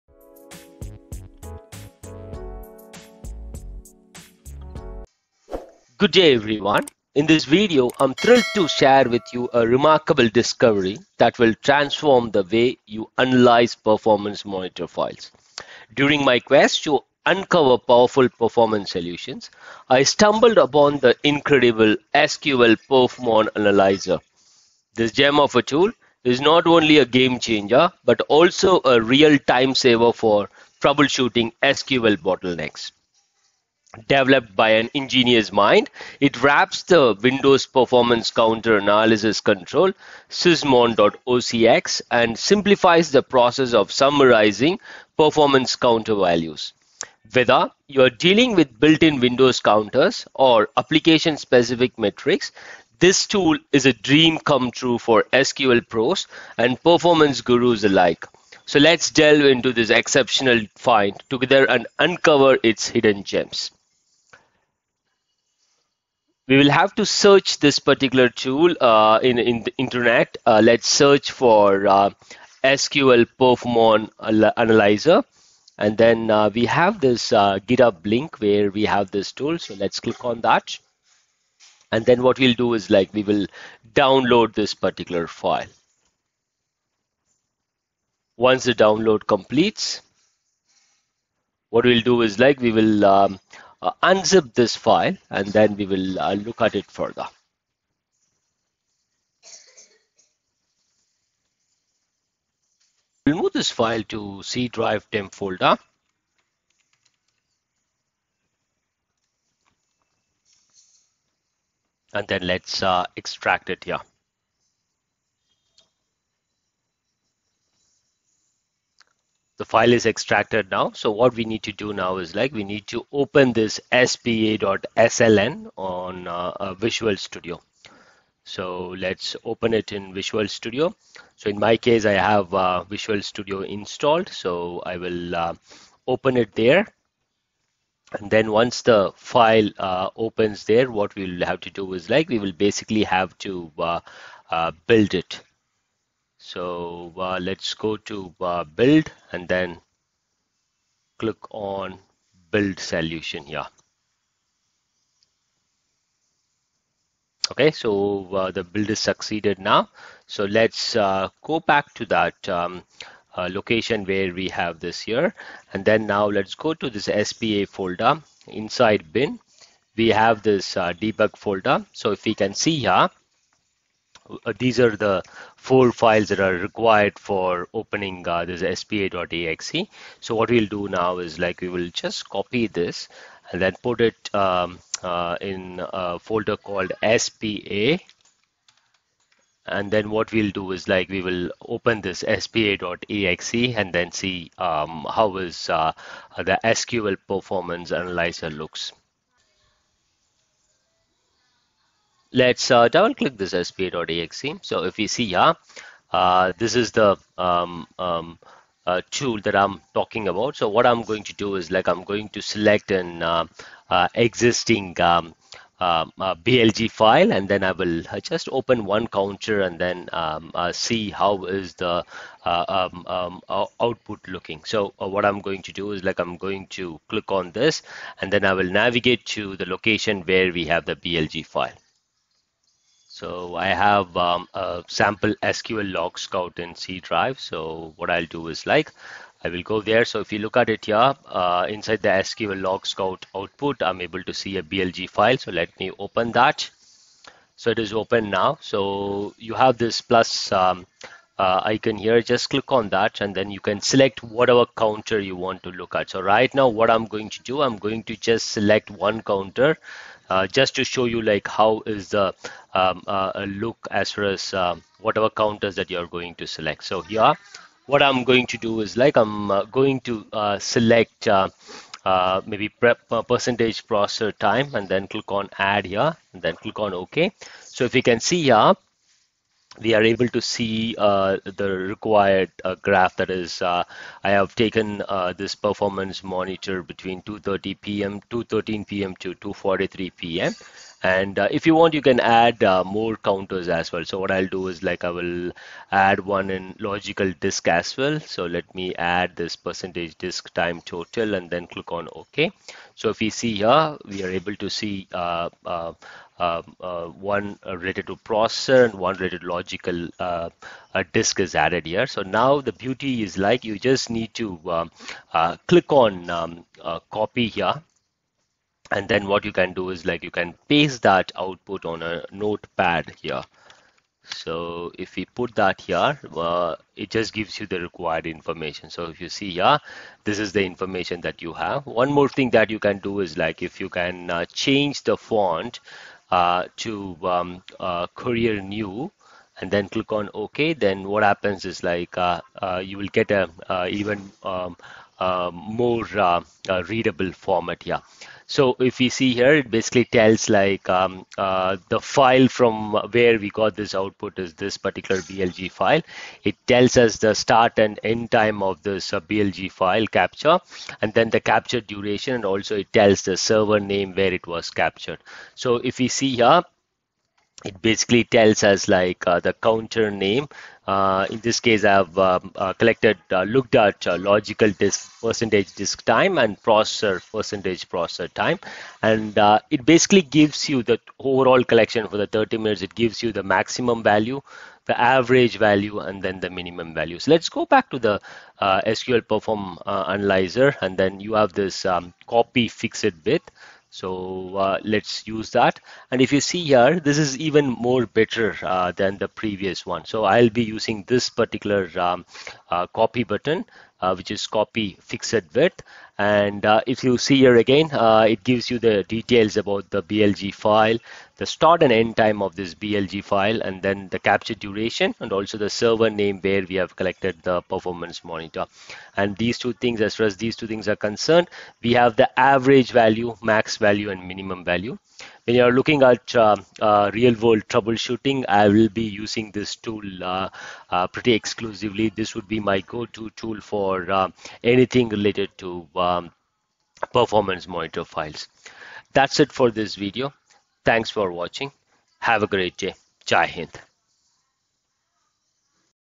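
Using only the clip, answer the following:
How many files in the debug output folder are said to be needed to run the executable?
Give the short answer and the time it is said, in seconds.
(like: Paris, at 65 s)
4, at 175 s.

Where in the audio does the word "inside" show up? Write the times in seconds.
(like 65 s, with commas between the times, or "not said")
168 s, 241 s.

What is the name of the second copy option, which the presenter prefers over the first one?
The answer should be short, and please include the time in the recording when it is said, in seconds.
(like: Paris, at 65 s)
copy fixed width, at 404 s.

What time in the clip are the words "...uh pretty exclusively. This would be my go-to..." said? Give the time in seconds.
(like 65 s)
430 s.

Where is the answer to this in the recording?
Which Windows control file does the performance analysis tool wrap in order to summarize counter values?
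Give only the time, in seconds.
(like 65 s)
40 s.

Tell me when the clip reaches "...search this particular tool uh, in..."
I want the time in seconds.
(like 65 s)
67 s.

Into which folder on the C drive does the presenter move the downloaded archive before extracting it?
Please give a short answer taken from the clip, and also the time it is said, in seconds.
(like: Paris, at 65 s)
temp, at 105 s.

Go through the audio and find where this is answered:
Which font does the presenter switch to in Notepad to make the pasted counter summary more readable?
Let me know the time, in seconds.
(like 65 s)
338 s.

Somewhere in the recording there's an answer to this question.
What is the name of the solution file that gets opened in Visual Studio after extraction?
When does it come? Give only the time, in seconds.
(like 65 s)
123 s.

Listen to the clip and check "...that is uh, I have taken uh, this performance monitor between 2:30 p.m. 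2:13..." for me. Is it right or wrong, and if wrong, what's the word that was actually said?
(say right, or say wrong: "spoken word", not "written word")
right.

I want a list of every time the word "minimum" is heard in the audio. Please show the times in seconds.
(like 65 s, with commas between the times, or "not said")
386 s, 424 s.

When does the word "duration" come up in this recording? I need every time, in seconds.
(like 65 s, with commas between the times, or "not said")
361 s, 414 s.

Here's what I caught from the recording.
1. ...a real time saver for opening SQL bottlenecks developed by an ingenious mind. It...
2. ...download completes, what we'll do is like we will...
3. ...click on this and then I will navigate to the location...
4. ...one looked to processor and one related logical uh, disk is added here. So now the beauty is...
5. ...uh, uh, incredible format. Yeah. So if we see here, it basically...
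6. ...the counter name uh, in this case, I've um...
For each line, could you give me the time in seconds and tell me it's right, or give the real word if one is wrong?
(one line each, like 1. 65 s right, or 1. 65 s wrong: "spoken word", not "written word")
1. 28 s wrong: "troubleshooting", not "opening"
2. 88 s right
3. 227 s right
4. 307 s wrong: "related", not "looked"
5. 346 s wrong: "readable", not "incredible"
6. 369 s right.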